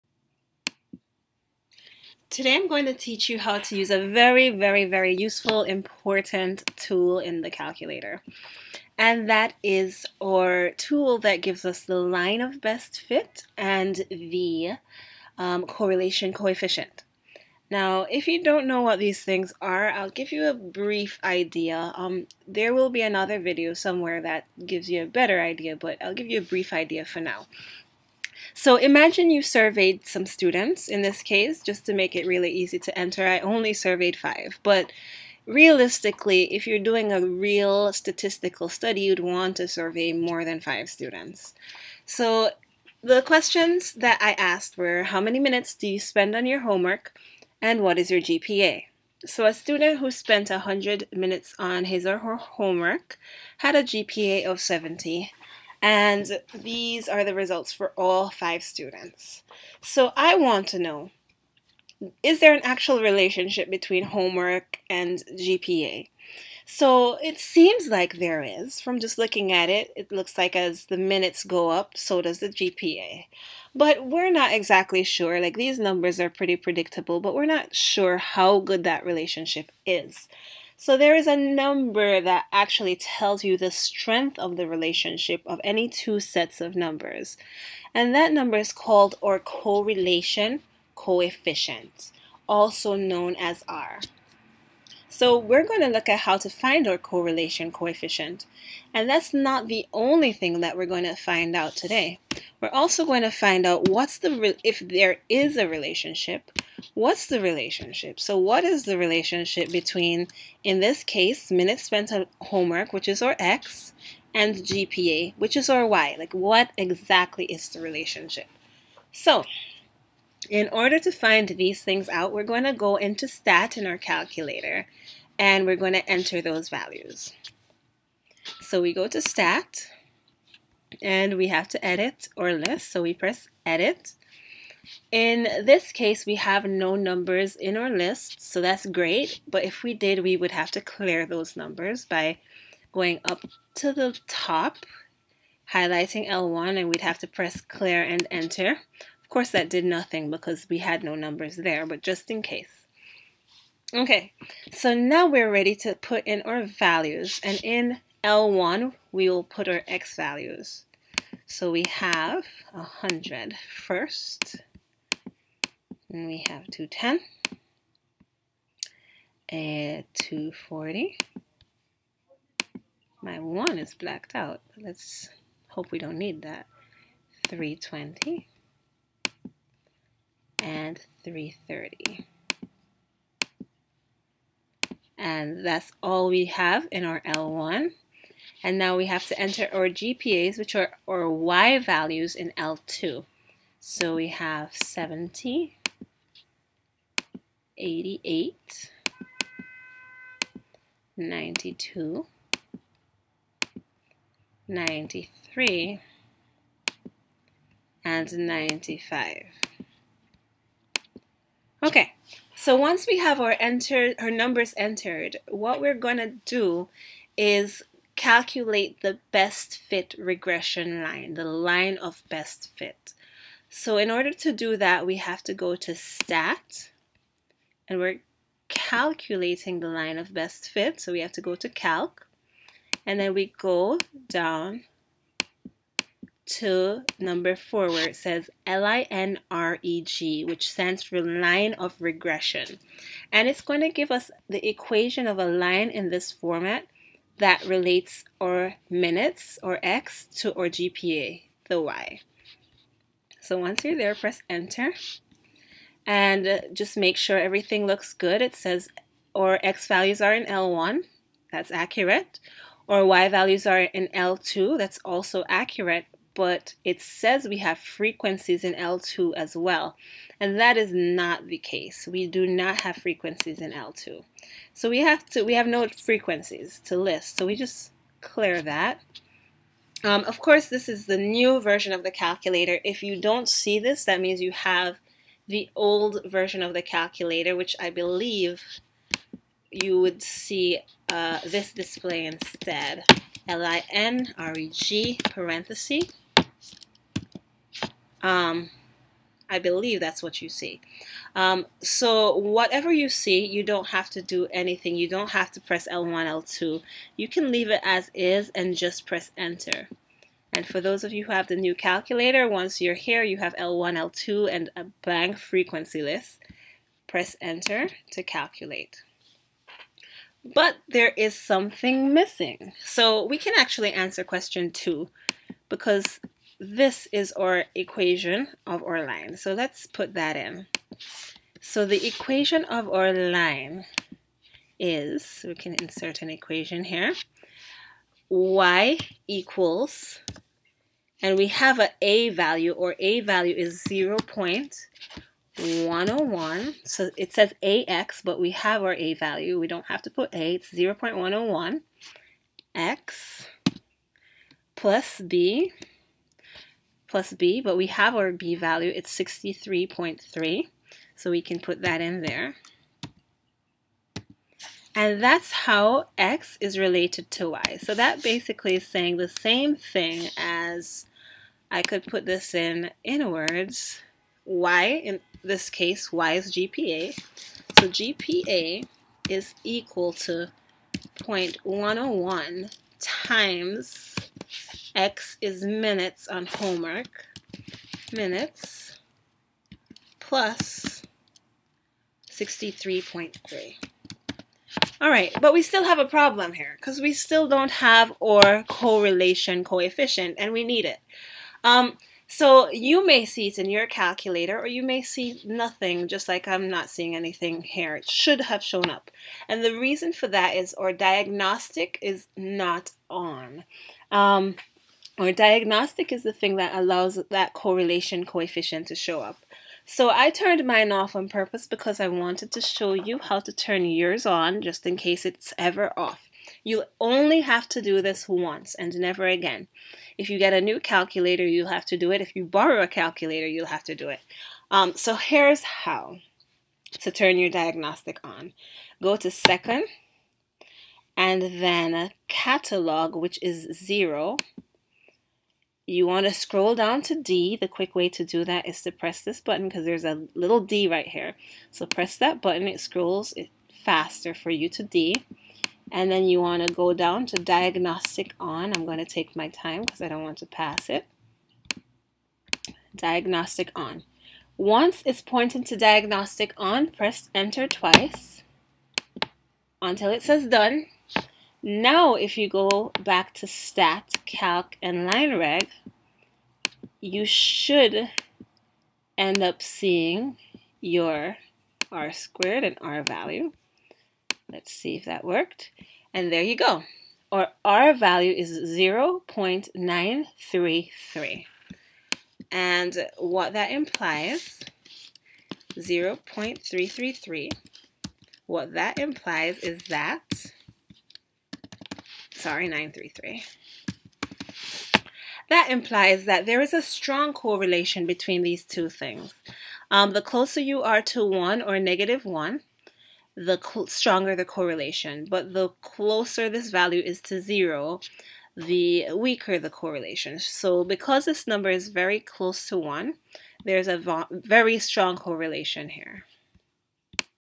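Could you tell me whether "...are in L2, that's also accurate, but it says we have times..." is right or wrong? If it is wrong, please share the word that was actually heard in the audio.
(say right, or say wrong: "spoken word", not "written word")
wrong: "frequencies", not "times".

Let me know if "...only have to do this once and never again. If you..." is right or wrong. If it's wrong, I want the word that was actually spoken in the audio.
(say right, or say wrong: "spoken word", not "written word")
right.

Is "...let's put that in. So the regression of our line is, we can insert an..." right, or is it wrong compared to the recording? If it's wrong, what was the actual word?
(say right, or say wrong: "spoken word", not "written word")
wrong: "equation", not "regression".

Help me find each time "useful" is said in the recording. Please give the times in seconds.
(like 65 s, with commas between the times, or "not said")
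5 s.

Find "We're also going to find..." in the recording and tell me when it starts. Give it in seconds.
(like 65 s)
102 s.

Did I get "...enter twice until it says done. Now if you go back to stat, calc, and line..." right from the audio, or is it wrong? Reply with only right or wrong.
right.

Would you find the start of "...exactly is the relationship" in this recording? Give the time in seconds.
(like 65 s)
116 s.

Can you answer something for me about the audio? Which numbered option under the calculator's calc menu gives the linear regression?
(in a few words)
number 4.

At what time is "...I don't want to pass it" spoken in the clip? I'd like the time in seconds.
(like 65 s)
460 s.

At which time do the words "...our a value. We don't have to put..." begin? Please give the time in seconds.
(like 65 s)
348 s.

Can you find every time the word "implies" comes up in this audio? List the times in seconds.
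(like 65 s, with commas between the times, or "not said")
493 s, 498 s, 505 s.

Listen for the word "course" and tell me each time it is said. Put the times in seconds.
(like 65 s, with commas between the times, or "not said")
149 s, 280 s.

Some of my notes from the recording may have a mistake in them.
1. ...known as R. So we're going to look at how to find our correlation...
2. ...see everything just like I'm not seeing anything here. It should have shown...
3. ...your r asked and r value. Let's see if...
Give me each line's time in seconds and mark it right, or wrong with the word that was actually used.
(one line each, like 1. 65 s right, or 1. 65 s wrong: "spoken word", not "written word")
1. 92 s right
2. 405 s wrong: "nothing", not "everything"
3. 480 s wrong: "squared", not "asked".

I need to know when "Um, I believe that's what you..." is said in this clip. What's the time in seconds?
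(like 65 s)
298 s.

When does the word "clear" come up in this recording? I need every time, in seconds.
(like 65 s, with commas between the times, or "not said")
140 s, 147 s, 278 s.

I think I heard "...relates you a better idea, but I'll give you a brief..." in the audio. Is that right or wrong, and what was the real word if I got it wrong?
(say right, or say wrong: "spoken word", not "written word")
wrong: "gives", not "relates".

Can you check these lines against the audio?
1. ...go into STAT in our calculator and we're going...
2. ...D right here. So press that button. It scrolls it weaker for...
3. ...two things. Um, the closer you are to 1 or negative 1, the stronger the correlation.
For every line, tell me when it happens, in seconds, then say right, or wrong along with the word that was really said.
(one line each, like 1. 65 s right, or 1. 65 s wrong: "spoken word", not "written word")
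1. 122 s right
2. 450 s wrong: "faster", not "weaker"
3. 508 s right.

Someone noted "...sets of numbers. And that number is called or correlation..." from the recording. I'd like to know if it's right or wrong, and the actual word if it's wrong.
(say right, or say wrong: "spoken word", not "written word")
right.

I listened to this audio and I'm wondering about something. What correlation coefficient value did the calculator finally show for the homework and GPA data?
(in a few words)
0.933.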